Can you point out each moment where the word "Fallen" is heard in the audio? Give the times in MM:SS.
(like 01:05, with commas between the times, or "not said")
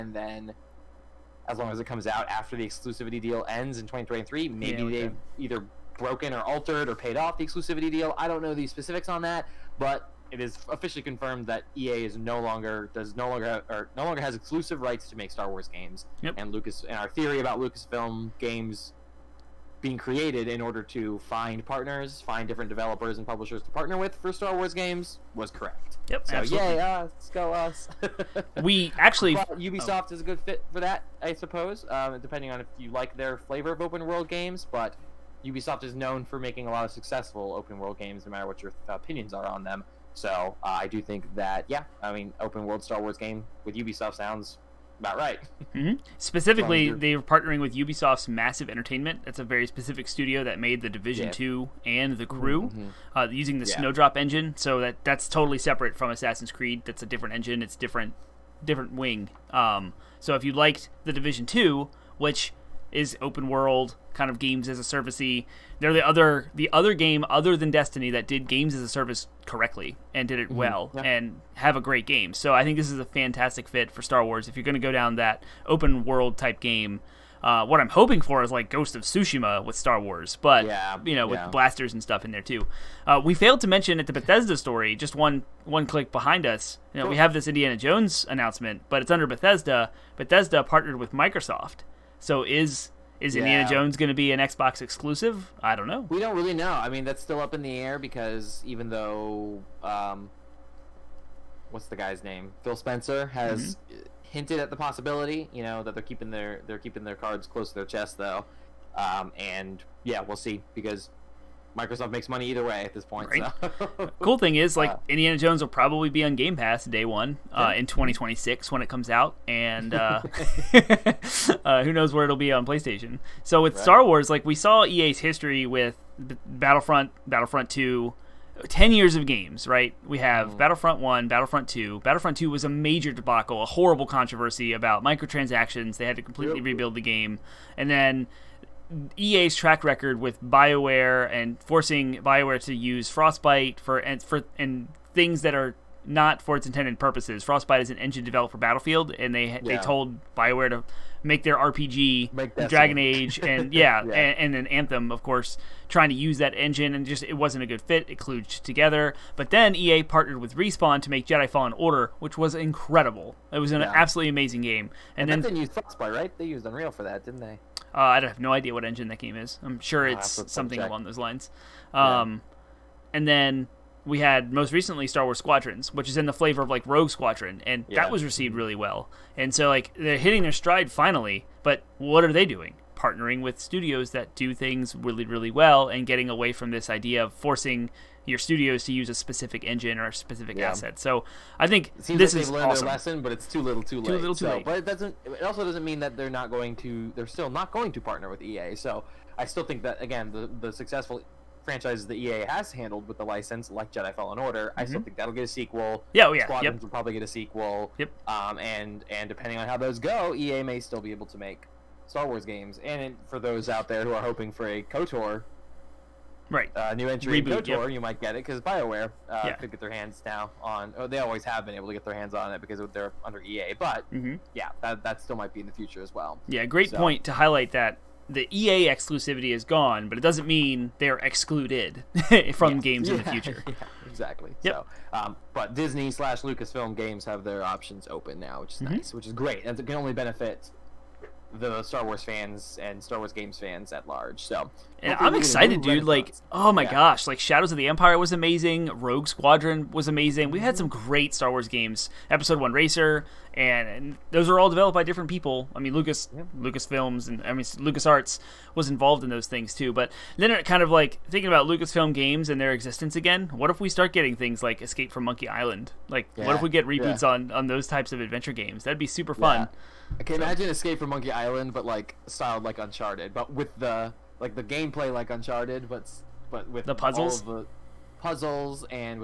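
02:41, 03:24.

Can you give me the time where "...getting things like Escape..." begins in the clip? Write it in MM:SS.
04:24.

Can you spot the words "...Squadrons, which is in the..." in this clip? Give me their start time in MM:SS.
02:55.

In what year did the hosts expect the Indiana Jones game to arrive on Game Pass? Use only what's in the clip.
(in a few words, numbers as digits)
2026.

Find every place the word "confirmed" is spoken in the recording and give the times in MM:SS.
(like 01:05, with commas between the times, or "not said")
00:11.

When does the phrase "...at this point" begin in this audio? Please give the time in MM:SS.
01:52.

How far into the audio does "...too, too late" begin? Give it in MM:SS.
03:13.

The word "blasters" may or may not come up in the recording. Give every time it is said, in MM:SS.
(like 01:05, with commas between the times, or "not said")
01:21.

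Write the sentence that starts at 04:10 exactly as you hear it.
We've had some great Star Wars games.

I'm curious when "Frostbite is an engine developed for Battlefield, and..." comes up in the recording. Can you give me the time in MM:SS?
02:27.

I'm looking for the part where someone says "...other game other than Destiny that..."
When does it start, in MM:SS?
01:06.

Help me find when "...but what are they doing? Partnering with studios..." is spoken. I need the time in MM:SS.
03:01.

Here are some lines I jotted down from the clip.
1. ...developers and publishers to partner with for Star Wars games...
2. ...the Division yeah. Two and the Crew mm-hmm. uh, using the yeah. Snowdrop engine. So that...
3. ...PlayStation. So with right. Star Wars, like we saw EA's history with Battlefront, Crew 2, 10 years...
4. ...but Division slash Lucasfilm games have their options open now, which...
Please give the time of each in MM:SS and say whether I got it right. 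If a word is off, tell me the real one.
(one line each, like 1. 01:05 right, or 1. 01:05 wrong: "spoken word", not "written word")
1. 00:22 right
2. 00:50 right
3. 02:02 wrong: "Battlefront", not "Crew"
4. 03:55 wrong: "Disney", not "Division".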